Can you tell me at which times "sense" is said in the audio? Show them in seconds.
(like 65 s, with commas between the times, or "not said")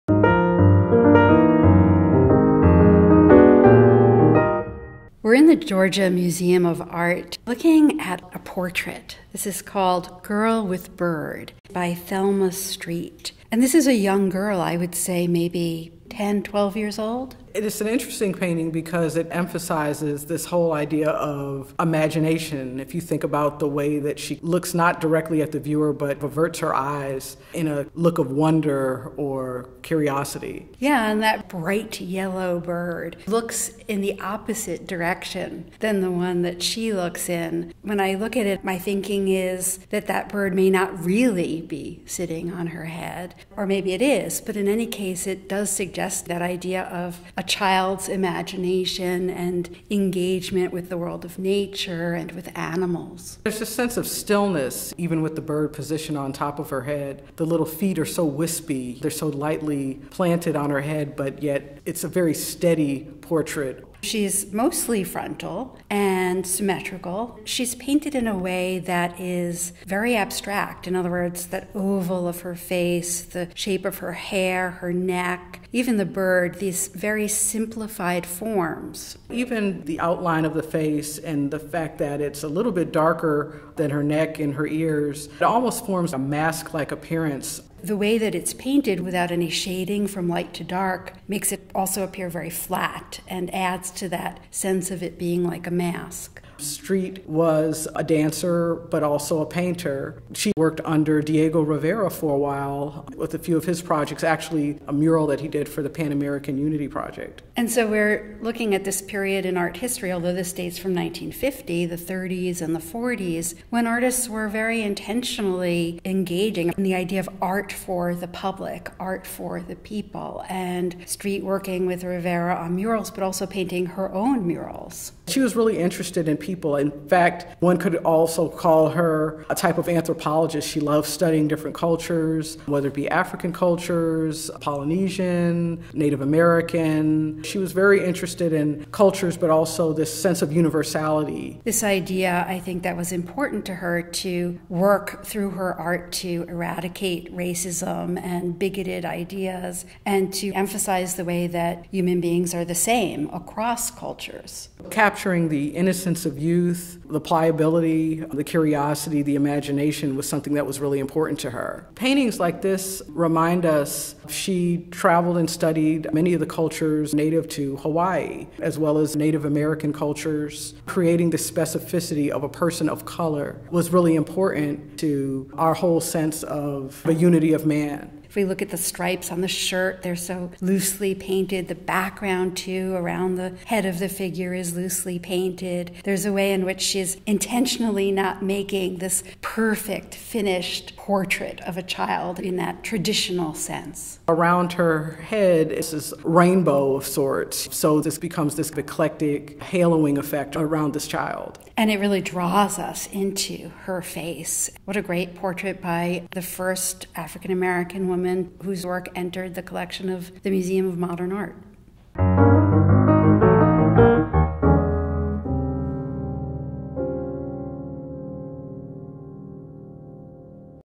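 53 s, 94 s, 140 s, 176 s, 193 s.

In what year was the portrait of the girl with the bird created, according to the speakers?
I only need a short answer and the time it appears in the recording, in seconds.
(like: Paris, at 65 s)
1950, at 110 s.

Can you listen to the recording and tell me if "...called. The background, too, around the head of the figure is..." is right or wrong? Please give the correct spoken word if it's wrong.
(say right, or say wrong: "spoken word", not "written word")
wrong: "painted", not "called".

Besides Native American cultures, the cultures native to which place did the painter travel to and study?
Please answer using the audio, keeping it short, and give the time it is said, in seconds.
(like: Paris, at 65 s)
Hawaii, at 167 s.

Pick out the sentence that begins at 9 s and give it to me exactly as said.
This is called Girl with Bird by Thelma Streat.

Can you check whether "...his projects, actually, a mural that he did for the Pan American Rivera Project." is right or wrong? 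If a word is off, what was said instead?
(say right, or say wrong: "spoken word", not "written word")
wrong: "Unity", not "Rivera".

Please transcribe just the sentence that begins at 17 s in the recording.
It is an interesting painting because it emphasizes this whole idea of imagination.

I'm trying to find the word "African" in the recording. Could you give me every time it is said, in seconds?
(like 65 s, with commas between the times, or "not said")
133 s, 207 s.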